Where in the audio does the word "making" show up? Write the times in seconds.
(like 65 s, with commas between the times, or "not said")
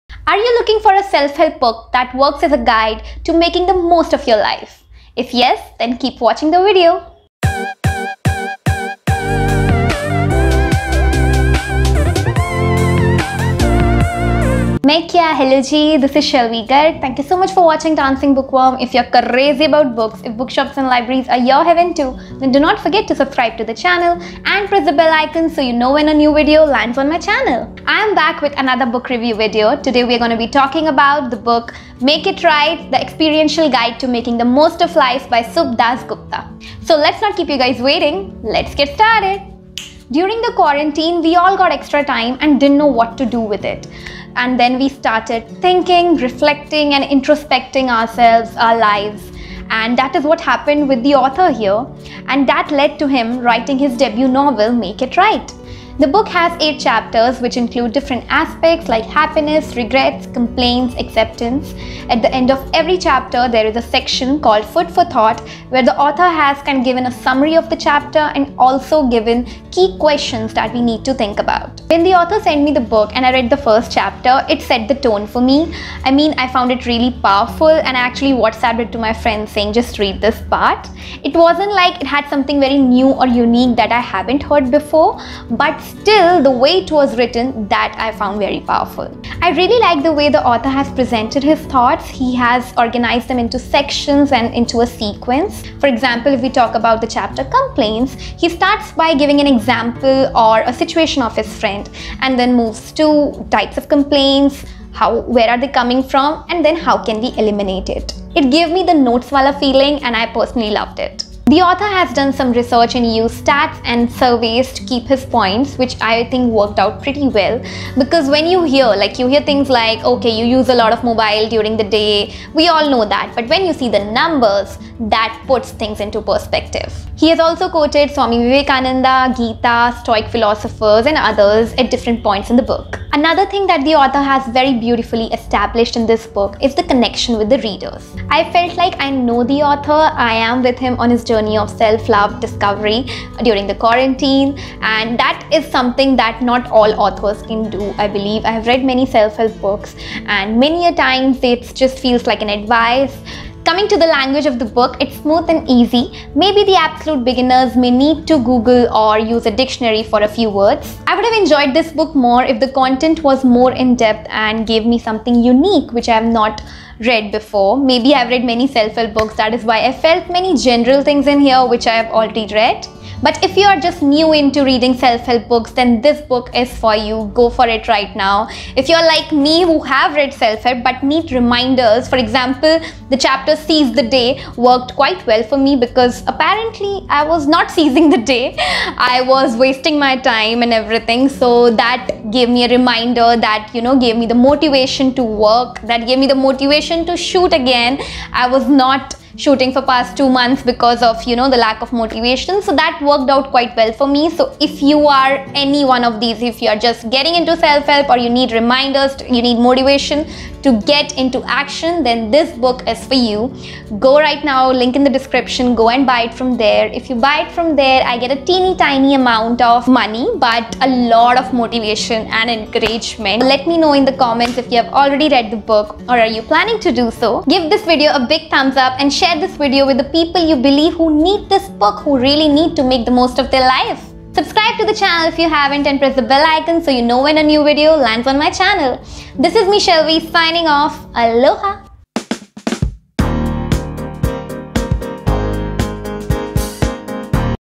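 3 s, 34 s.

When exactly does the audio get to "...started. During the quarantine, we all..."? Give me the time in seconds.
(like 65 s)
38 s.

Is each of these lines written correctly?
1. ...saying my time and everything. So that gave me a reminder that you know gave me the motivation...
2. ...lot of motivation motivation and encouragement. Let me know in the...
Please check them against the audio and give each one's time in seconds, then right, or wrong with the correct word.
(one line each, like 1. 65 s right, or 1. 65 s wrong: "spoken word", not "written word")
1. 189 s wrong: "wasting", not "saying"
2. 221 s right.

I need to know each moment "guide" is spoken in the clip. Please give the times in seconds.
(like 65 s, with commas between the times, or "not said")
2 s, 33 s.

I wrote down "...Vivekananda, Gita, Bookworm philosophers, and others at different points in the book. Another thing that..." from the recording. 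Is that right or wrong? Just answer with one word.
wrong.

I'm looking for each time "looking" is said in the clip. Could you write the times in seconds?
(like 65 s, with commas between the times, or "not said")
0 s.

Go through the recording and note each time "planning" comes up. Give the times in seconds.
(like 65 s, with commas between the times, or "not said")
226 s.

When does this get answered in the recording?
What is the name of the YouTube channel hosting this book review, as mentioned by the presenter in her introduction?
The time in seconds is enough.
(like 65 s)
17 s.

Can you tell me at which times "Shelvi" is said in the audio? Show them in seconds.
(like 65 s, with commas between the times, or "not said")
16 s, 239 s.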